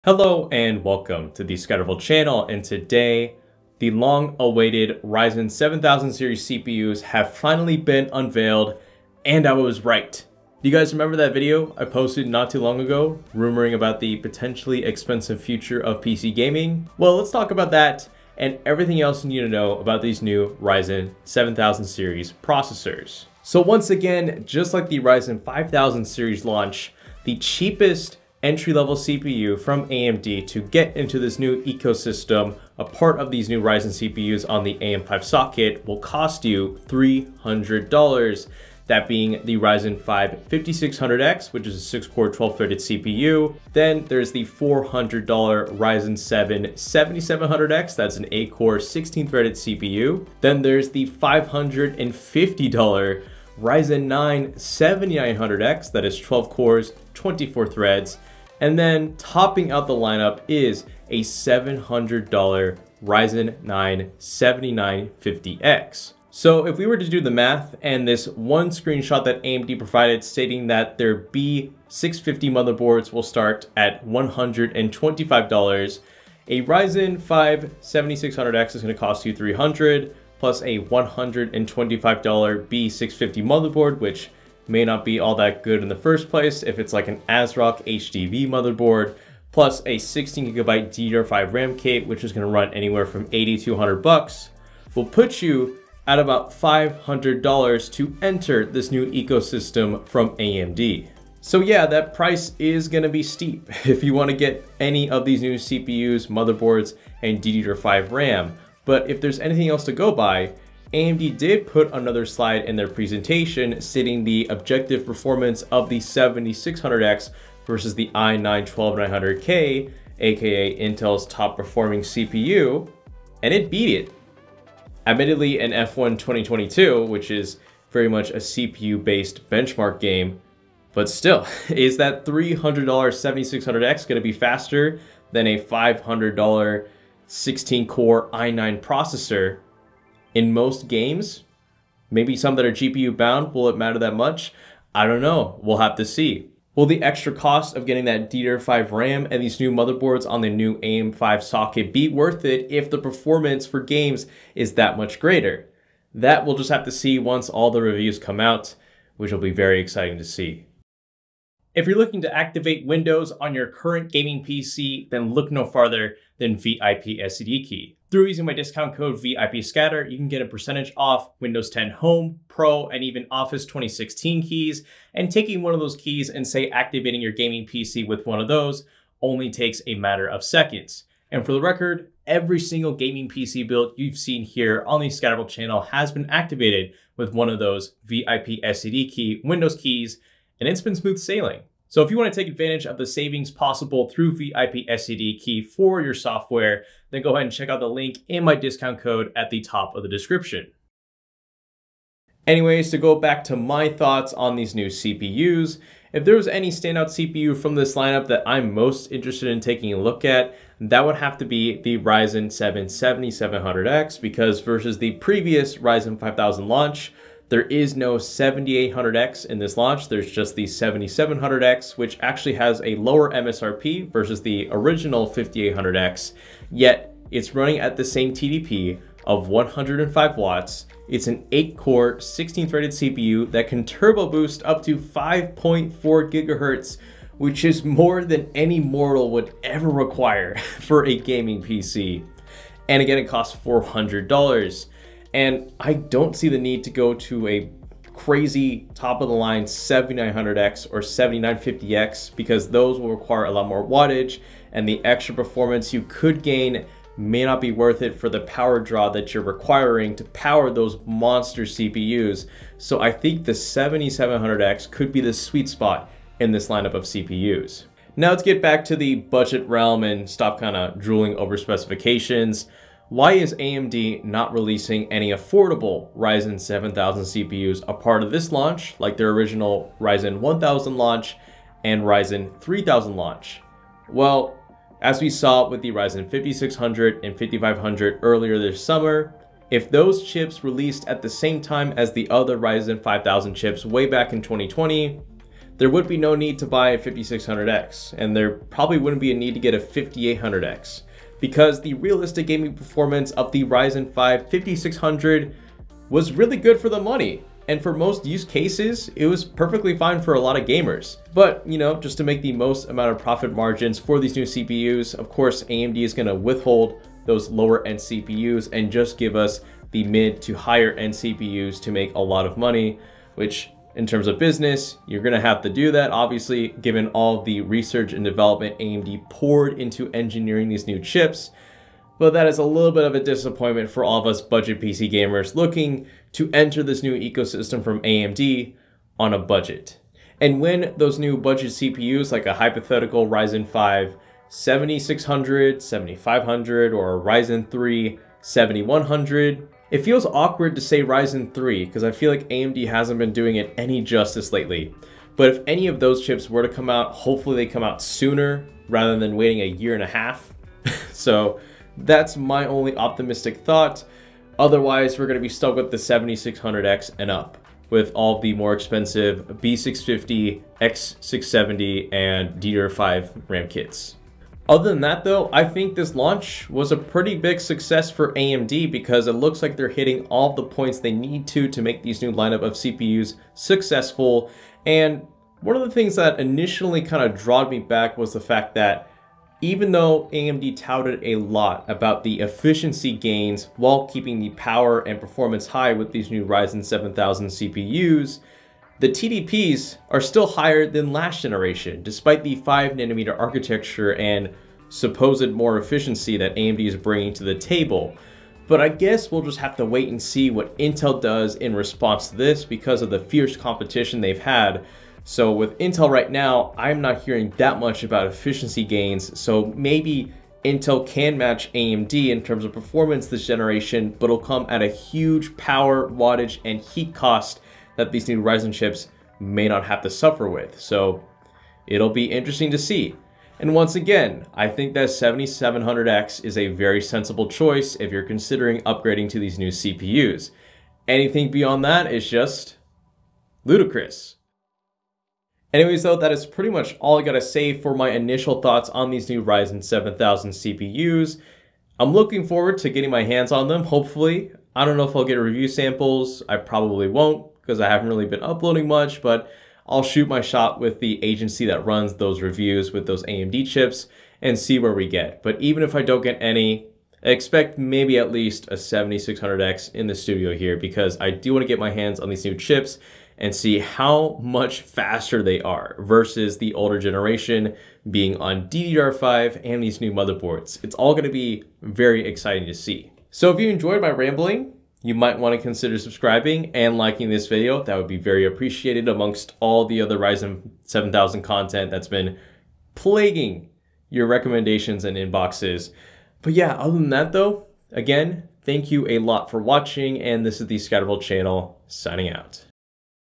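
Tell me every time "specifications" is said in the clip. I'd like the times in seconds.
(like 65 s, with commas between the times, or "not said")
271 s.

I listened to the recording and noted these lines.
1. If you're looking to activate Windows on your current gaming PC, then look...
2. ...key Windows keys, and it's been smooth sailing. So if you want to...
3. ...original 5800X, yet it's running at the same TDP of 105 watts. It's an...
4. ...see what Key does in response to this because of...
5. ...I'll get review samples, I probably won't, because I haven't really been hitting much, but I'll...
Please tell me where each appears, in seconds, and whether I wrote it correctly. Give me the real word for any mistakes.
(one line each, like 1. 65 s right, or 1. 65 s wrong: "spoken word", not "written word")
1. 161 s right
2. 189 s right
3. 224 s right
4. 410 s wrong: "Intel", not "Key"
5. 455 s wrong: "uploading", not "hitting".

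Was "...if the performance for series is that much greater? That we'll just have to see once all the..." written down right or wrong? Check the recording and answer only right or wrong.
wrong.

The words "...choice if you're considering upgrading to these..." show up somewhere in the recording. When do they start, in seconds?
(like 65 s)
437 s.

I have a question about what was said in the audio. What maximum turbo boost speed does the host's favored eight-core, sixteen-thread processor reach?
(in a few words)
5.4 GHz.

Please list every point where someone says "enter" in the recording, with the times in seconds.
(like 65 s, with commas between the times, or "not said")
98 s, 336 s.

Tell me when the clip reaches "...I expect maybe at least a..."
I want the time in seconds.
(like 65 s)
467 s.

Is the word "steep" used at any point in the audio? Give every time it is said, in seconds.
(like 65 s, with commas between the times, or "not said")
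103 s.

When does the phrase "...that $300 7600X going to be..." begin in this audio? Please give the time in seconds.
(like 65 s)
131 s.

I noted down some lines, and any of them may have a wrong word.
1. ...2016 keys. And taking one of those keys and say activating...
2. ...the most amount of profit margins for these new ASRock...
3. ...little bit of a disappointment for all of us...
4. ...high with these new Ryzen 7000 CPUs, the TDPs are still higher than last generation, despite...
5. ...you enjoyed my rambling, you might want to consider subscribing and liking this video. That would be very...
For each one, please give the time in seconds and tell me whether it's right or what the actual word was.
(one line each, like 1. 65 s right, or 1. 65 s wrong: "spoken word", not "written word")
1. 173 s right
2. 312 s wrong: "CPUs", not "ASRock"
3. 332 s right
4. 395 s right
5. 483 s right.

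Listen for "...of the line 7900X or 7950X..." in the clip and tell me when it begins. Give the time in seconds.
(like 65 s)
249 s.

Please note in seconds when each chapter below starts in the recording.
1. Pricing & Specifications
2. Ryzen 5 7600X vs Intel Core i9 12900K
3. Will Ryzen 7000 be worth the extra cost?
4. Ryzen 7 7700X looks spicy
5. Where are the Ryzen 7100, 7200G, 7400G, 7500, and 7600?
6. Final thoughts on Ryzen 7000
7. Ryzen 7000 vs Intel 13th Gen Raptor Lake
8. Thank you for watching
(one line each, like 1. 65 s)
1. 26 s
2. 108 s
3. 130 s
4. 202 s
5. 268 s
6. 374 s
7. 408 s
8. 446 s.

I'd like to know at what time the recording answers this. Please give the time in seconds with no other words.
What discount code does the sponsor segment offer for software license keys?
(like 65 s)
169 s.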